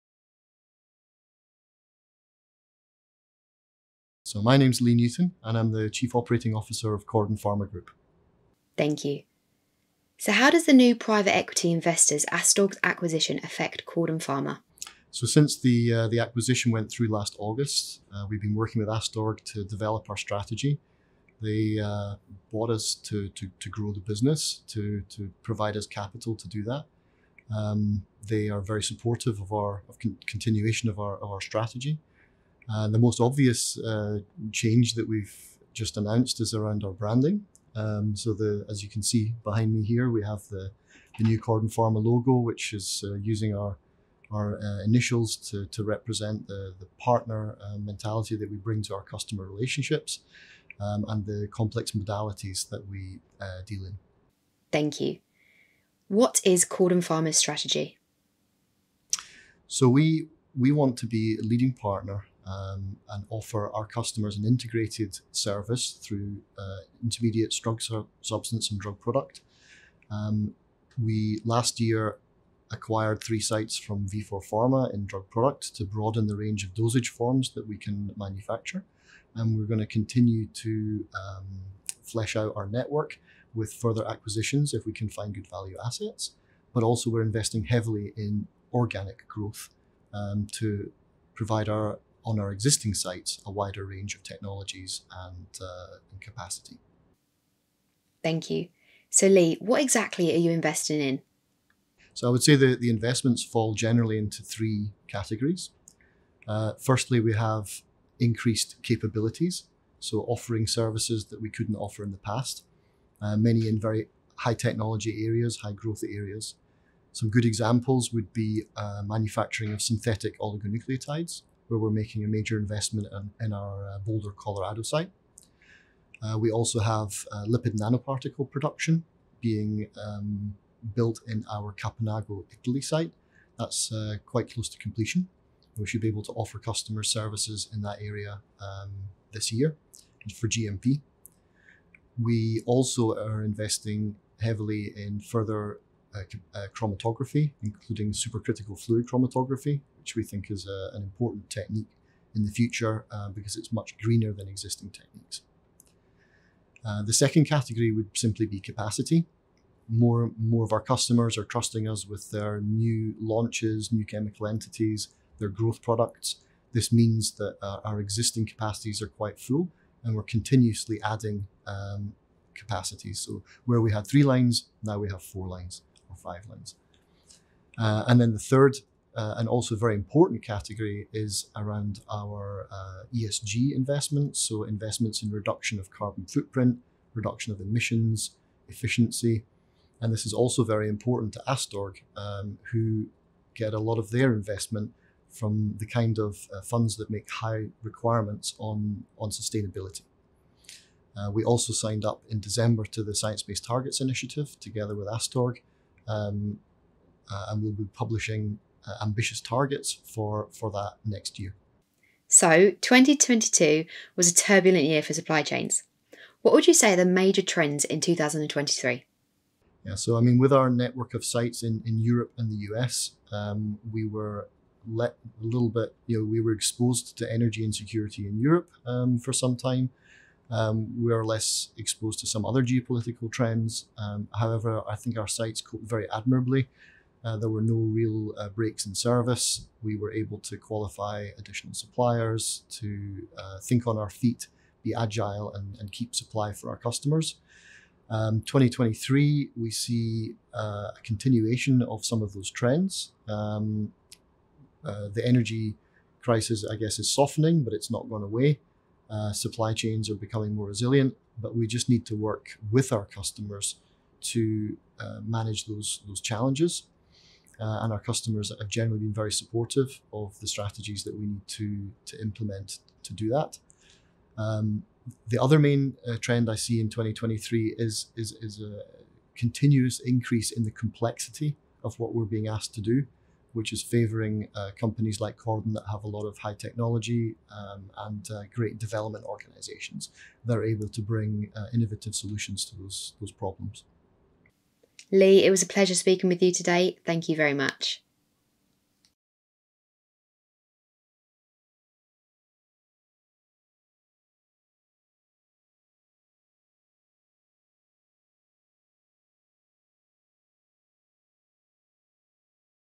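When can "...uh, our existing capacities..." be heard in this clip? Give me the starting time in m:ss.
2:47.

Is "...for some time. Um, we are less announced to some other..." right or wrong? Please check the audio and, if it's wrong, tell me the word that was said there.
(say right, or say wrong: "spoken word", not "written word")
wrong: "exposed", not "announced".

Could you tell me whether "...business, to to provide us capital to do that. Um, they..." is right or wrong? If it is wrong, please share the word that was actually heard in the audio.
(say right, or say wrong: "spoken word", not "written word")
right.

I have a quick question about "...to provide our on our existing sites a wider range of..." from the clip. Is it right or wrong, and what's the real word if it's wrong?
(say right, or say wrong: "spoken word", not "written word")
right.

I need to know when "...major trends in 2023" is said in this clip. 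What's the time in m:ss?
3:37.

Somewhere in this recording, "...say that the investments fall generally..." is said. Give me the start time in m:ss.
1:42.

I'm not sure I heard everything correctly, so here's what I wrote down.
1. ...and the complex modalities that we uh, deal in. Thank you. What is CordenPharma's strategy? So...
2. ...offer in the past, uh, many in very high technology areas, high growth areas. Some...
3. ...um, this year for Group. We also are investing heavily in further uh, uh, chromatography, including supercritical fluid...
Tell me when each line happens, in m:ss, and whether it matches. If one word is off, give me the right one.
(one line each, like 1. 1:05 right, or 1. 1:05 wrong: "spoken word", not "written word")
1. 0:51 right
2. 1:51 right
3. 2:18 wrong: "GMP", not "Group".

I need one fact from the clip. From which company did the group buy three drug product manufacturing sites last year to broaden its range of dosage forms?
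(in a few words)
Vifor Pharma.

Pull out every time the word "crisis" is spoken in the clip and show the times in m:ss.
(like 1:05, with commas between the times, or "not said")
4:16.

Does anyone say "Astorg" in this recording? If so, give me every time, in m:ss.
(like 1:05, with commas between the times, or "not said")
0:12, 0:18, 3:11, 3:25.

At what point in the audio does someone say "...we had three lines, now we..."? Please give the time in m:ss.
2:53.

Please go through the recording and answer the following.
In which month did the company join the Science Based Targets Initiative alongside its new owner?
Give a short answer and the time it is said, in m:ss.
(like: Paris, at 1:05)
December, at 3:22.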